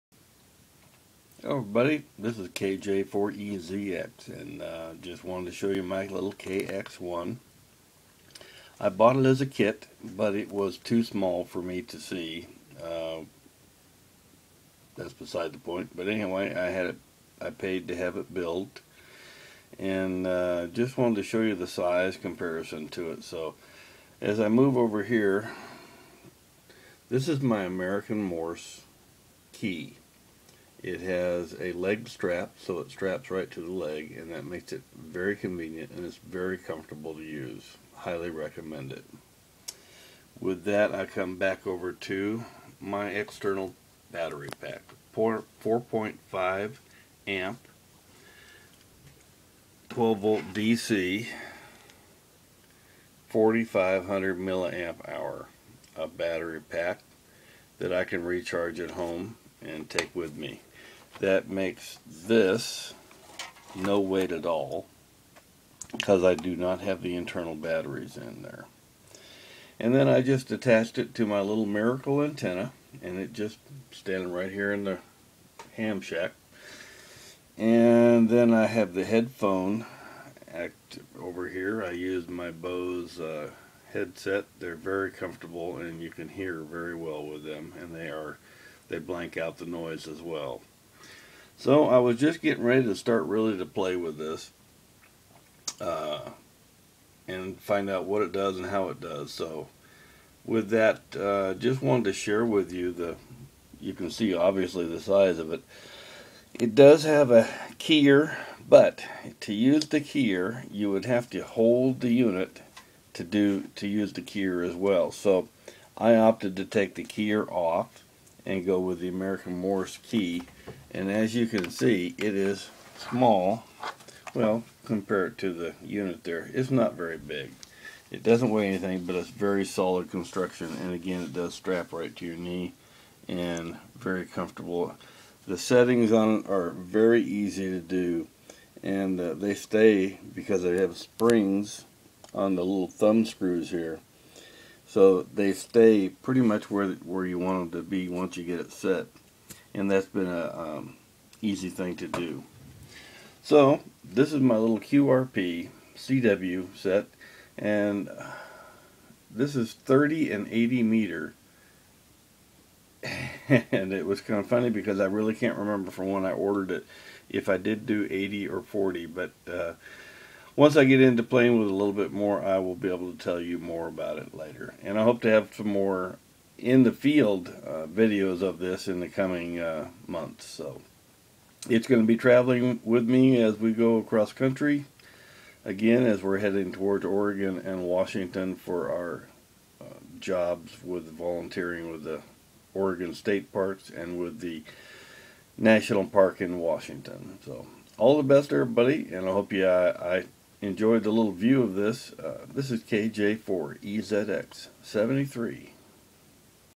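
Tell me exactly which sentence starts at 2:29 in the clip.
And that's been a um, easy thing to do.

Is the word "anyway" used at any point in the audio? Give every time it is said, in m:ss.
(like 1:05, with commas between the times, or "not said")
0:16.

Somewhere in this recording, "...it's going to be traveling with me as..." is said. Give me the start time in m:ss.
3:01.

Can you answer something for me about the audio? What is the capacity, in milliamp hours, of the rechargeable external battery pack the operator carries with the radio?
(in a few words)
4500.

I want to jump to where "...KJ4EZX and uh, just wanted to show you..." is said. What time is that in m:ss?
0:02.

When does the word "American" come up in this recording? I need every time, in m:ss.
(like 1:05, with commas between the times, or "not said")
0:27, 1:59.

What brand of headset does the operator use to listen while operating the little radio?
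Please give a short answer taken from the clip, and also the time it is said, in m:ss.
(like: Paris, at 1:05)
Bose, at 1:22.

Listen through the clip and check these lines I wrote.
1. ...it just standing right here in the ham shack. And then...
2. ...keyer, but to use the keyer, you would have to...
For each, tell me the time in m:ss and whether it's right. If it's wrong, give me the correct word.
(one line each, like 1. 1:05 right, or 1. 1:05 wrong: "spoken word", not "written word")
1. 1:13 right
2. 1:47 right.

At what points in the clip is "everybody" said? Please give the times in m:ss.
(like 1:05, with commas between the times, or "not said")
0:01, 3:18.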